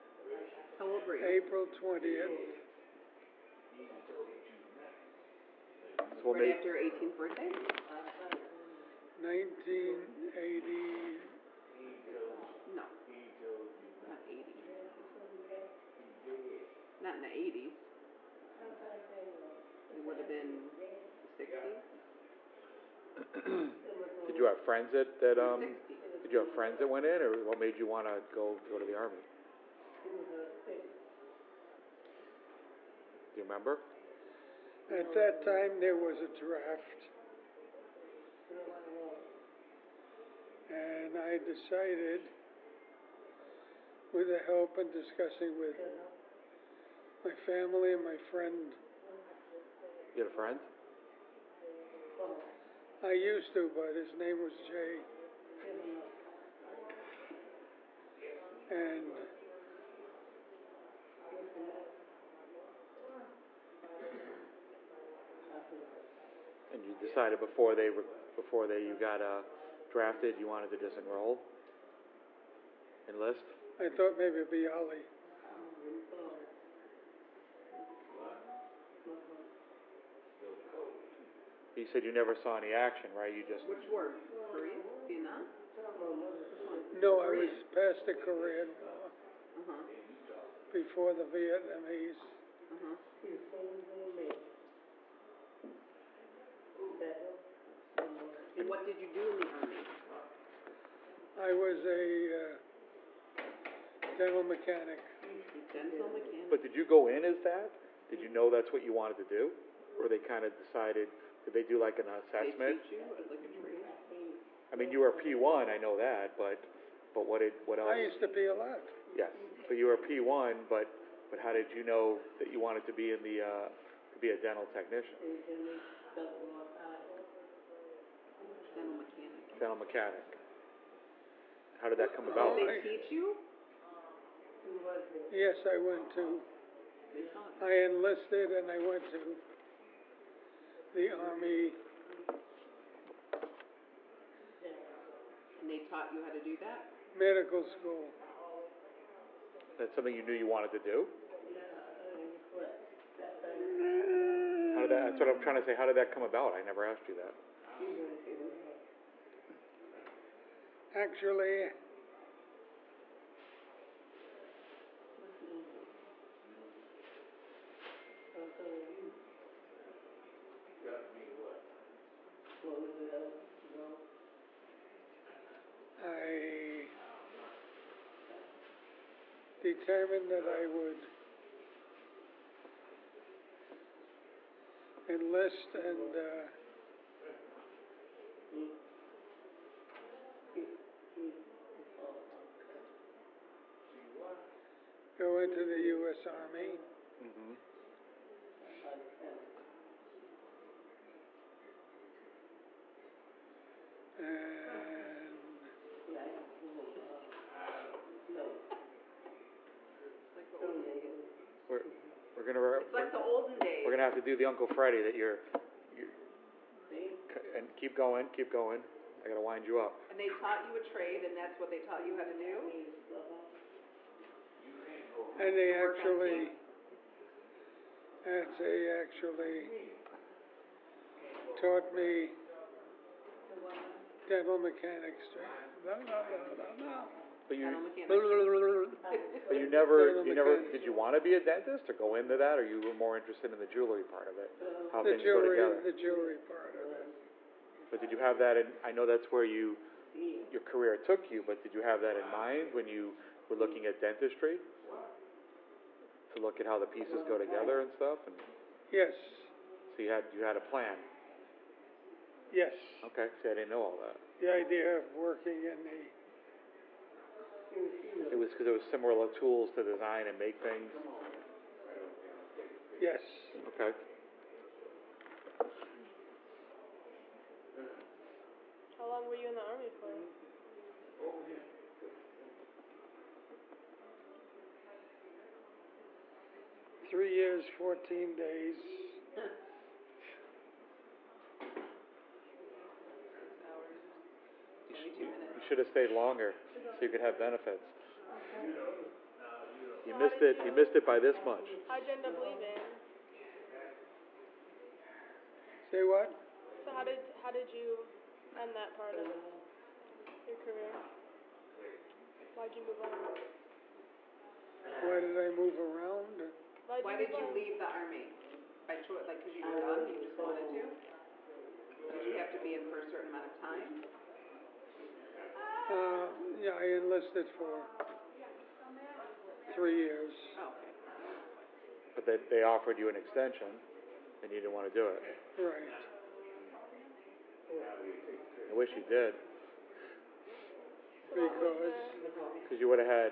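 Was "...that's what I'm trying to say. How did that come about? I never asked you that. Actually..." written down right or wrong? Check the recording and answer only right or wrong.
right.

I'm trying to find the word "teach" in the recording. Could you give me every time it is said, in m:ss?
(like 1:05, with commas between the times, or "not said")
1:52, 2:12.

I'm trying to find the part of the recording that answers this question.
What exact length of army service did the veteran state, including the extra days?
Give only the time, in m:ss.
4:47.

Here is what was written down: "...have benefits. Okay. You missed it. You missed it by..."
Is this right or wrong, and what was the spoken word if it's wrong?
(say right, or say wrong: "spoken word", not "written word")
right.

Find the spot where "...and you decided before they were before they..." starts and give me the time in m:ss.
1:06.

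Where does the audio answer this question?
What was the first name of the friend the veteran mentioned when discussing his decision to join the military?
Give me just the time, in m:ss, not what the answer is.
0:54.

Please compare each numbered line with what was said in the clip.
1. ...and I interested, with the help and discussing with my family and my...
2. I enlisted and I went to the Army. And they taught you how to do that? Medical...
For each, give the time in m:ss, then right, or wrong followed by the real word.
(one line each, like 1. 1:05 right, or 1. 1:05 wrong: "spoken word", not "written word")
1. 0:40 wrong: "decided", not "interested"
2. 2:17 right.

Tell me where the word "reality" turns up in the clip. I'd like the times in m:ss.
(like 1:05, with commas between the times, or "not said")
not said.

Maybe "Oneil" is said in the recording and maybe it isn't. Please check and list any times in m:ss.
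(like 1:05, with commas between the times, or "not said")
not said.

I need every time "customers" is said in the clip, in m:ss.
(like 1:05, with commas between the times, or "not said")
not said.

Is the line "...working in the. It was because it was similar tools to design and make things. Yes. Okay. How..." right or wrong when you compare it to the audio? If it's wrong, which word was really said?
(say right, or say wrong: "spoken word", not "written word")
right.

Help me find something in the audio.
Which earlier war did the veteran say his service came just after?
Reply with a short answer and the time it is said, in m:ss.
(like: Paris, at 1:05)
Korean War, at 1:28.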